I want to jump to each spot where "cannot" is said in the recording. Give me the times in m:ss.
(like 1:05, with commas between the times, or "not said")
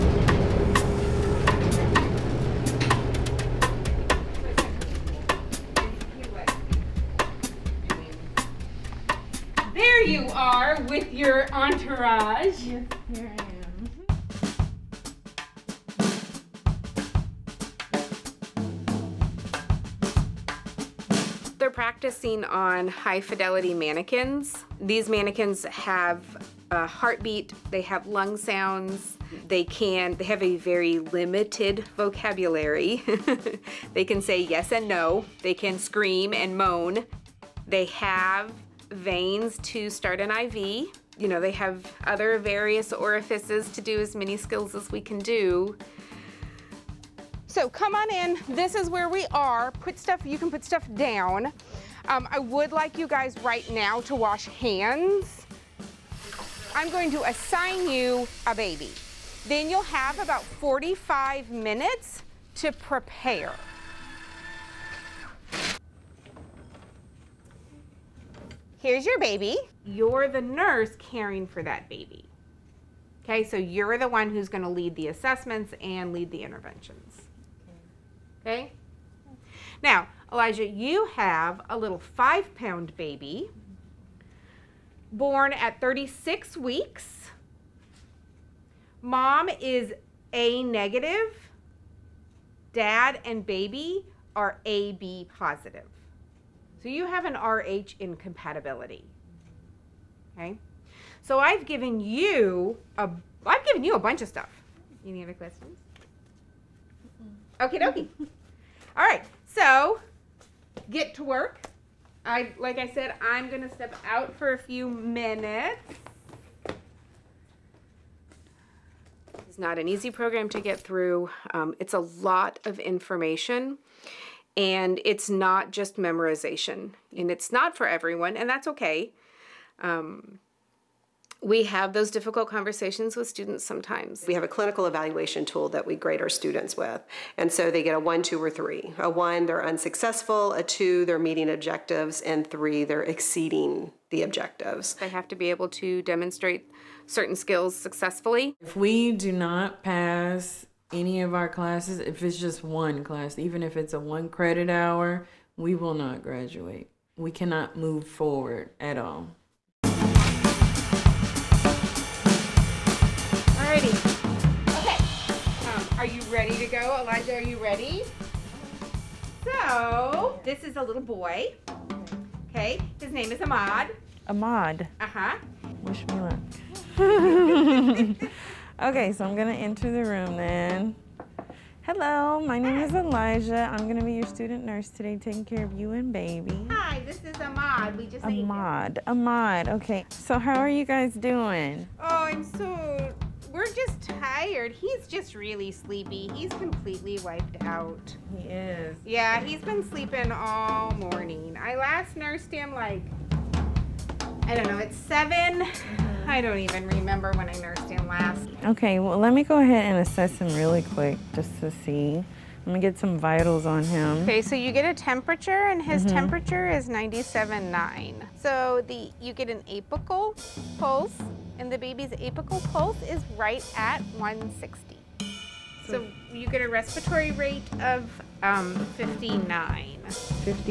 2:37.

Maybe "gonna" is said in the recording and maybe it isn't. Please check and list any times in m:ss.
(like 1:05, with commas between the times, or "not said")
1:14, 1:53.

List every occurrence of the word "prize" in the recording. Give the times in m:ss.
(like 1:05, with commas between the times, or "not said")
not said.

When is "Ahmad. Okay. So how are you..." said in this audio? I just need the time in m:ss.
3:09.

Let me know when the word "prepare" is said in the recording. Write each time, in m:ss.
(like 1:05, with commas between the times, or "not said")
1:02.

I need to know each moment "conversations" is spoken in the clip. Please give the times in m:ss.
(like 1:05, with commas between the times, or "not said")
2:12.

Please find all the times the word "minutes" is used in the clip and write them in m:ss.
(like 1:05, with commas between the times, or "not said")
1:01, 1:54.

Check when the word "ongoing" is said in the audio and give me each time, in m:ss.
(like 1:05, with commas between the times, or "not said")
not said.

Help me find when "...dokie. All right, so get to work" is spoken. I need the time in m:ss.
1:47.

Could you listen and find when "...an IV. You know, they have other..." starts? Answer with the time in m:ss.
0:40.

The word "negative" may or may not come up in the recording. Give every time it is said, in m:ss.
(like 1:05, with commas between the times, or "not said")
1:30.